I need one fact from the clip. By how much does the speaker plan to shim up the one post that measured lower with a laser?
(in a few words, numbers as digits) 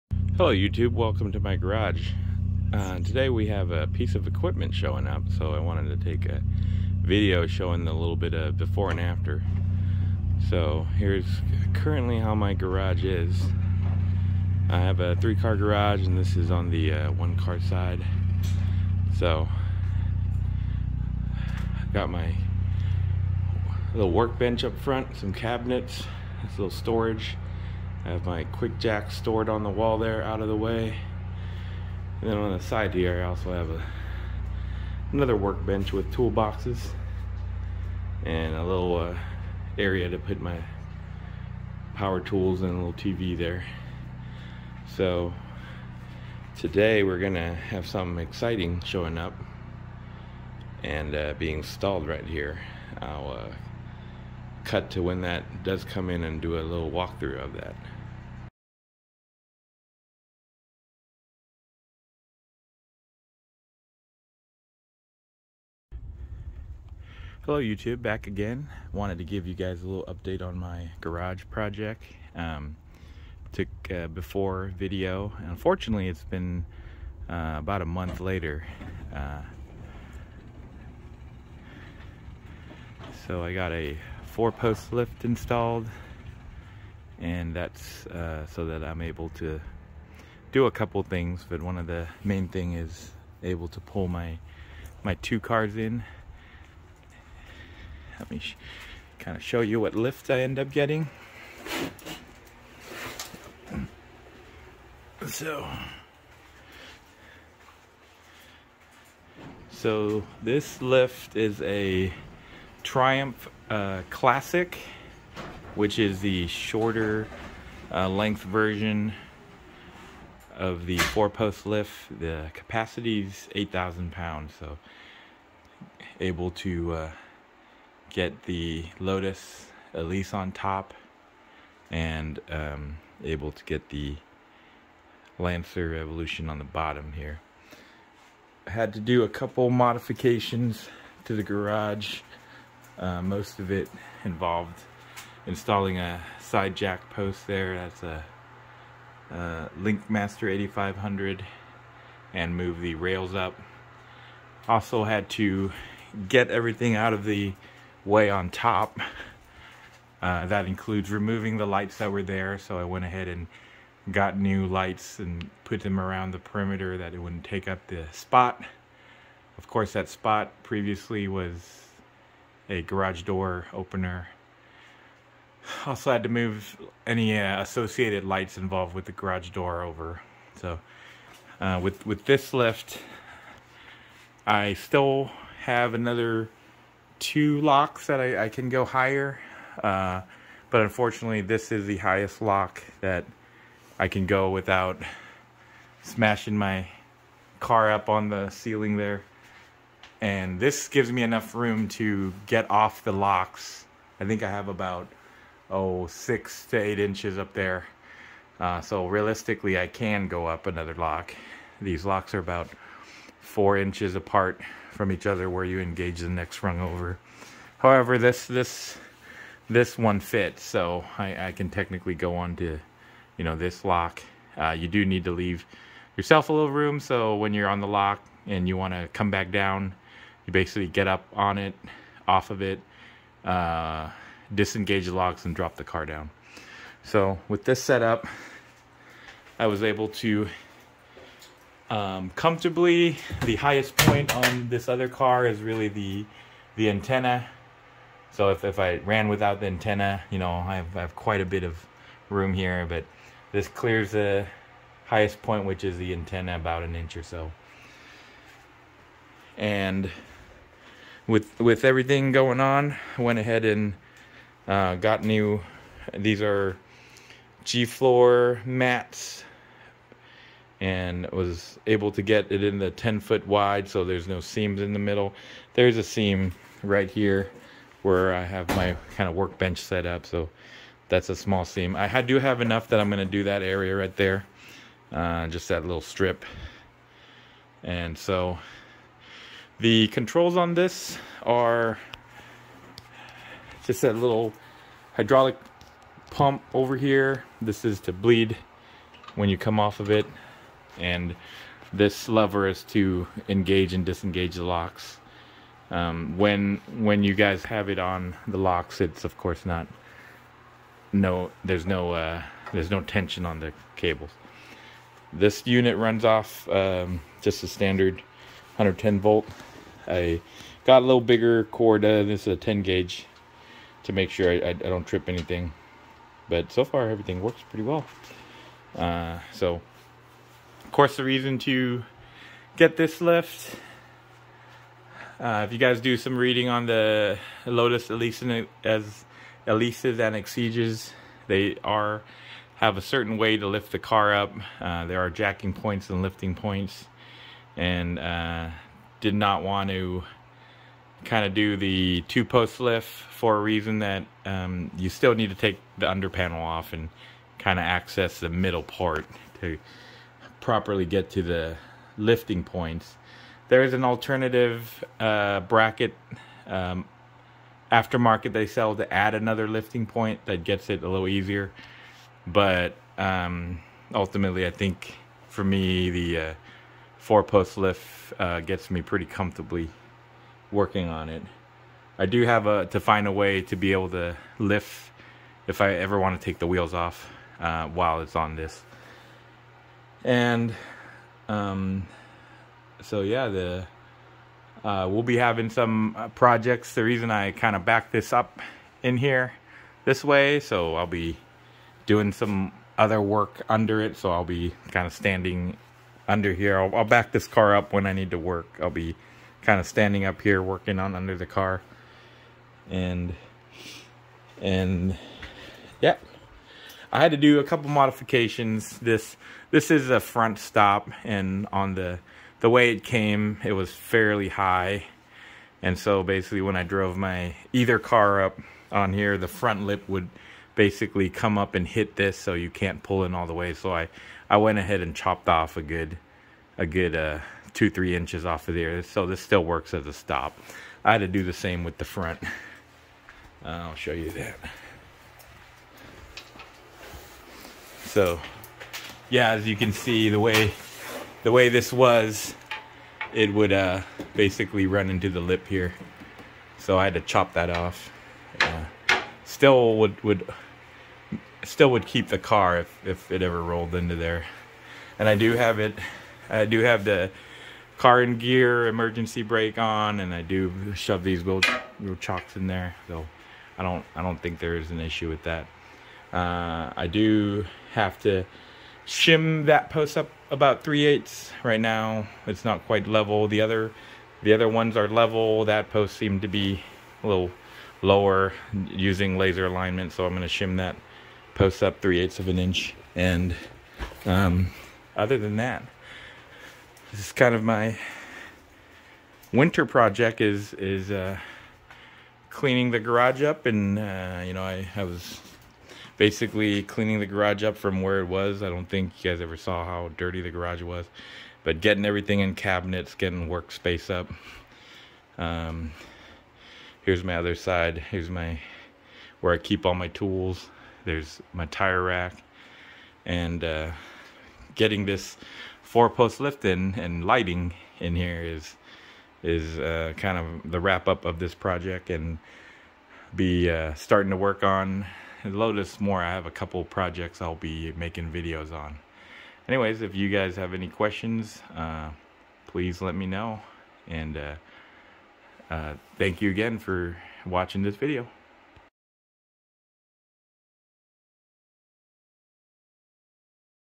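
3/8 inch.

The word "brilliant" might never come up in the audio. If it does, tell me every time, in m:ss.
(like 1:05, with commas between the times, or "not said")
not said.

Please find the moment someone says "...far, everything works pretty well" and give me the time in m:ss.
5:26.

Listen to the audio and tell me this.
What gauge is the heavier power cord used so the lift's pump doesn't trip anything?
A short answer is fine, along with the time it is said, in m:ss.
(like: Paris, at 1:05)
10 gauge, at 5:22.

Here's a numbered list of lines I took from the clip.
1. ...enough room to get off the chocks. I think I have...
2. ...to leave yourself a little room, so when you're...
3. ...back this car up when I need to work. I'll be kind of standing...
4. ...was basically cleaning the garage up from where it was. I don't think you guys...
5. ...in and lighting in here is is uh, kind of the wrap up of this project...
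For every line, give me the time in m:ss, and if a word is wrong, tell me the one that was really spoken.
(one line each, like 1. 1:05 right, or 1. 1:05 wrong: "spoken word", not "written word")
1. 3:21 wrong: "locks", not "chocks"
2. 3:45 right
3. 6:47 right
4. 8:25 right
5. 8:46 right.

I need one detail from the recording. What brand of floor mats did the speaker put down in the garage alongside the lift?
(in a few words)
G-Floor.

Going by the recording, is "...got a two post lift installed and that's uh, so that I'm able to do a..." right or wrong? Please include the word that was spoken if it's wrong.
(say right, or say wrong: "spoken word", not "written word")
wrong: "four", not "two".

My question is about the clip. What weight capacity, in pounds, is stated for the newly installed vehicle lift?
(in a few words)
8,000 pounds.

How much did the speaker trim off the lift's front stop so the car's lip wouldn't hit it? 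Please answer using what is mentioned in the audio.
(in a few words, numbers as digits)
2 to 3 inches.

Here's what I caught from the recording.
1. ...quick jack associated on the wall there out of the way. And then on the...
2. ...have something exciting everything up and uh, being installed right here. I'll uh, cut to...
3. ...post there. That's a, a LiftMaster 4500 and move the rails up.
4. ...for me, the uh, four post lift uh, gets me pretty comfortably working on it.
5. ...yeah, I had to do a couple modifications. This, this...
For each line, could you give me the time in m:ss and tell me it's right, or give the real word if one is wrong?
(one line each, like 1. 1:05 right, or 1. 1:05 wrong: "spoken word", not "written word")
1. 0:28 wrong: "stored", not "associated"
2. 0:47 wrong: "showing", not "everything"
3. 2:27 wrong: "8500", not "4500"
4. 6:15 right
5. 6:56 right.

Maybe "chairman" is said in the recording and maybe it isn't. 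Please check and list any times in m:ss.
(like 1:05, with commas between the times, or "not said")
not said.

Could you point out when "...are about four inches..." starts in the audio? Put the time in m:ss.
3:32.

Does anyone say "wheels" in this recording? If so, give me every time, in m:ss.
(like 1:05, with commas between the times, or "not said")
6:26, 7:51.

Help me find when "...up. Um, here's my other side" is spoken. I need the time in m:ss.
8:34.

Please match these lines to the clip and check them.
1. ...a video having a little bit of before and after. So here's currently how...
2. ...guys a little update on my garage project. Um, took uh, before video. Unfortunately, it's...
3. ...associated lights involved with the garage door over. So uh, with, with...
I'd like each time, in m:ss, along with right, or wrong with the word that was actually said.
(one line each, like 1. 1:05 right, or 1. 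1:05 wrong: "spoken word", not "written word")
1. 0:06 wrong: "showing", not "having"
2. 1:09 right
3. 2:57 right.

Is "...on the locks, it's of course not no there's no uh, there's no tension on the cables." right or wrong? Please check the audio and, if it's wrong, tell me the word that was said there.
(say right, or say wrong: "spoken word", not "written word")
right.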